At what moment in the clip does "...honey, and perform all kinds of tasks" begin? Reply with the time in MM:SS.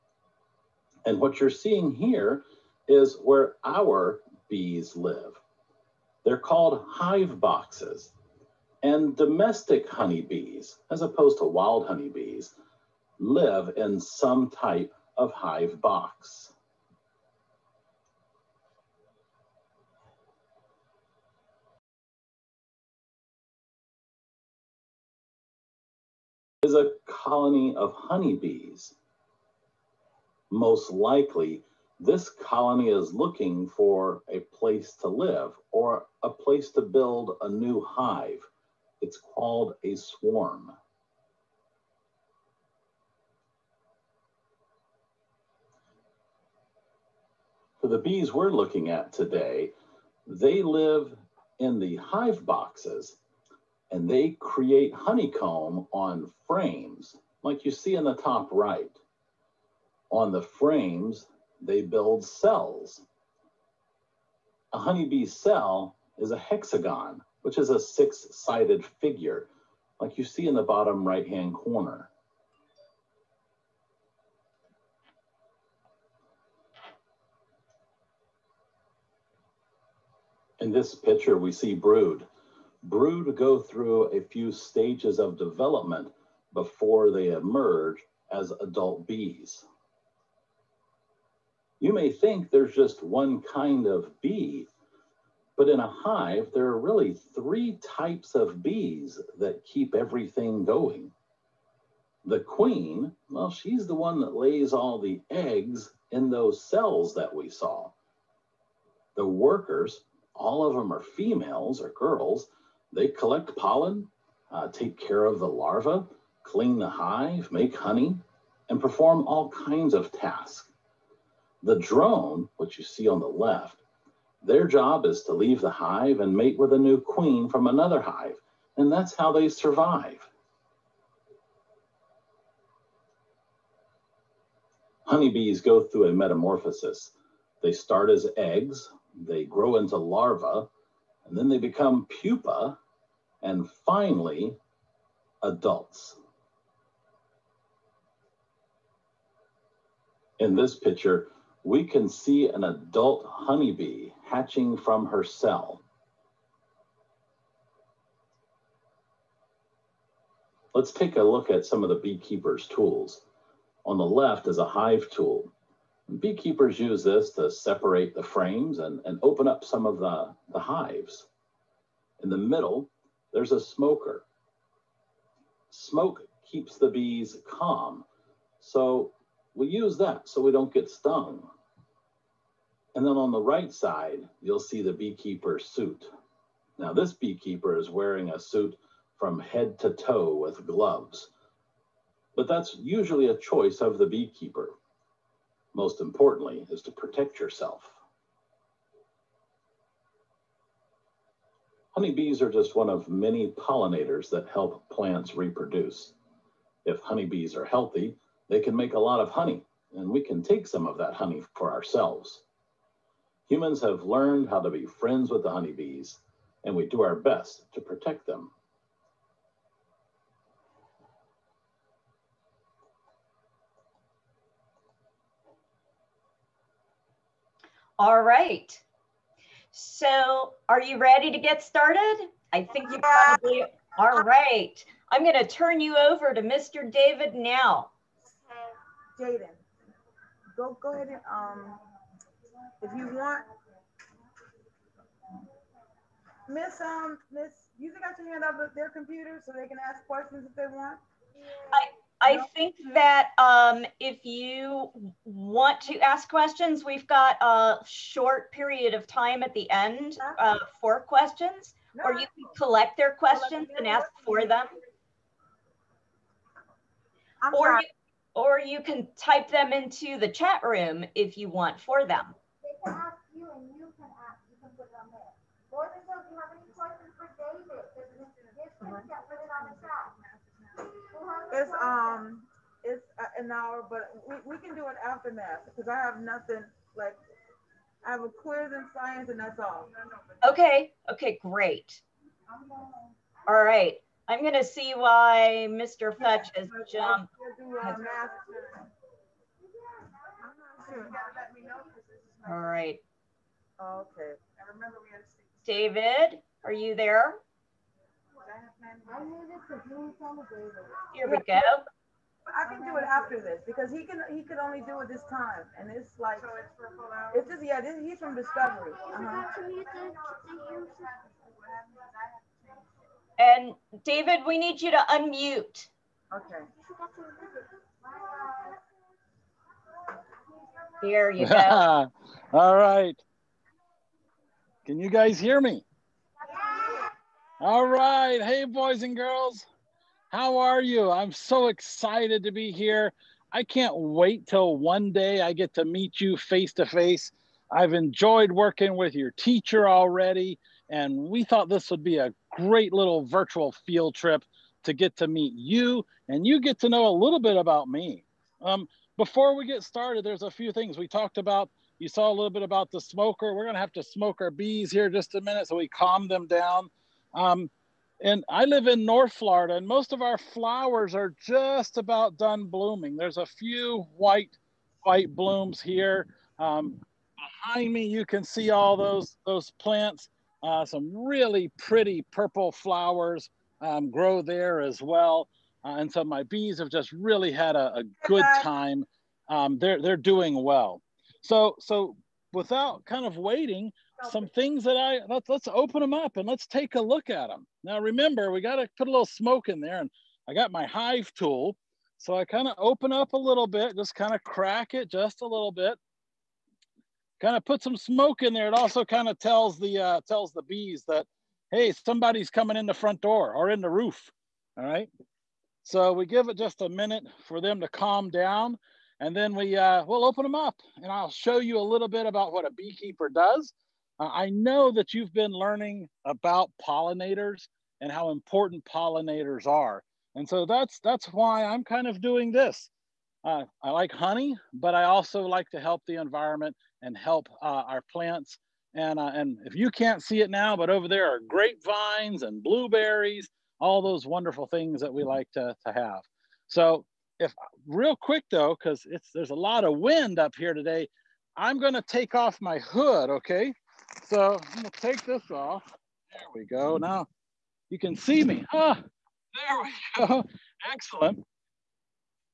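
01:57.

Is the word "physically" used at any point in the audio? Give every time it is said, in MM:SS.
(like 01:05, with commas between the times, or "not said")
not said.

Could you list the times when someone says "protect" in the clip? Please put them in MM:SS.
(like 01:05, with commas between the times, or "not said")
03:16, 03:37.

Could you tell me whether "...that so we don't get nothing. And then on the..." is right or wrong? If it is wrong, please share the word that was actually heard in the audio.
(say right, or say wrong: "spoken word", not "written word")
wrong: "stung", not "nothing".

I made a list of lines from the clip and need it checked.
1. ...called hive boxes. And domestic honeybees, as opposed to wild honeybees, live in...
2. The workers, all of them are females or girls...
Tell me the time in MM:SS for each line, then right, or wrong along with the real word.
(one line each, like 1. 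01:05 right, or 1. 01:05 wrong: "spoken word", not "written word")
1. 00:06 right
2. 01:49 right.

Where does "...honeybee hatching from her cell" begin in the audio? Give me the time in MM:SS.
02:33.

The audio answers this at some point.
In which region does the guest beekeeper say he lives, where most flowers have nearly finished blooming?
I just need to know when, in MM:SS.
06:09.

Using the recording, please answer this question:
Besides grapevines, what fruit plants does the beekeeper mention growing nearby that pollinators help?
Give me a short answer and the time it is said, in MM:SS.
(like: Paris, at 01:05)
blueberries, at 07:22.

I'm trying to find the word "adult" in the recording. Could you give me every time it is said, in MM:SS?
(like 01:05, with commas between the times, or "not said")
01:28, 02:25, 02:32.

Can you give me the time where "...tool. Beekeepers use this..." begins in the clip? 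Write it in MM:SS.
02:45.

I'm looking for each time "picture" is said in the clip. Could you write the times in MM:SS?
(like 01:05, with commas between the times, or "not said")
01:20, 02:30.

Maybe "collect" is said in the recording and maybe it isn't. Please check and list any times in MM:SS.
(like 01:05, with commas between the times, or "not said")
01:53, 04:22.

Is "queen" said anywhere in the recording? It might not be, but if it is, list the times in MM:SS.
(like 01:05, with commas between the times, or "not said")
01:42, 02:07.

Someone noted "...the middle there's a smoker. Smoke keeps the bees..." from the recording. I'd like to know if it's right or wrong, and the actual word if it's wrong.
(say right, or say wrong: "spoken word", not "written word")
right.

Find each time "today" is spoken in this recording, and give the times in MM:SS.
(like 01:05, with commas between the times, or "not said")
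00:49, 07:30.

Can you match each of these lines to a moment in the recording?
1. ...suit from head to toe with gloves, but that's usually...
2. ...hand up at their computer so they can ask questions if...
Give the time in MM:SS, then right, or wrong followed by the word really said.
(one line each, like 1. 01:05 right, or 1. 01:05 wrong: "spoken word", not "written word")
1. 03:08 right
2. 04:08 right.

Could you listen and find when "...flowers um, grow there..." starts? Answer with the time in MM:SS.
06:22.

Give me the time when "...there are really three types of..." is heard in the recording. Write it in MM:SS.
01:36.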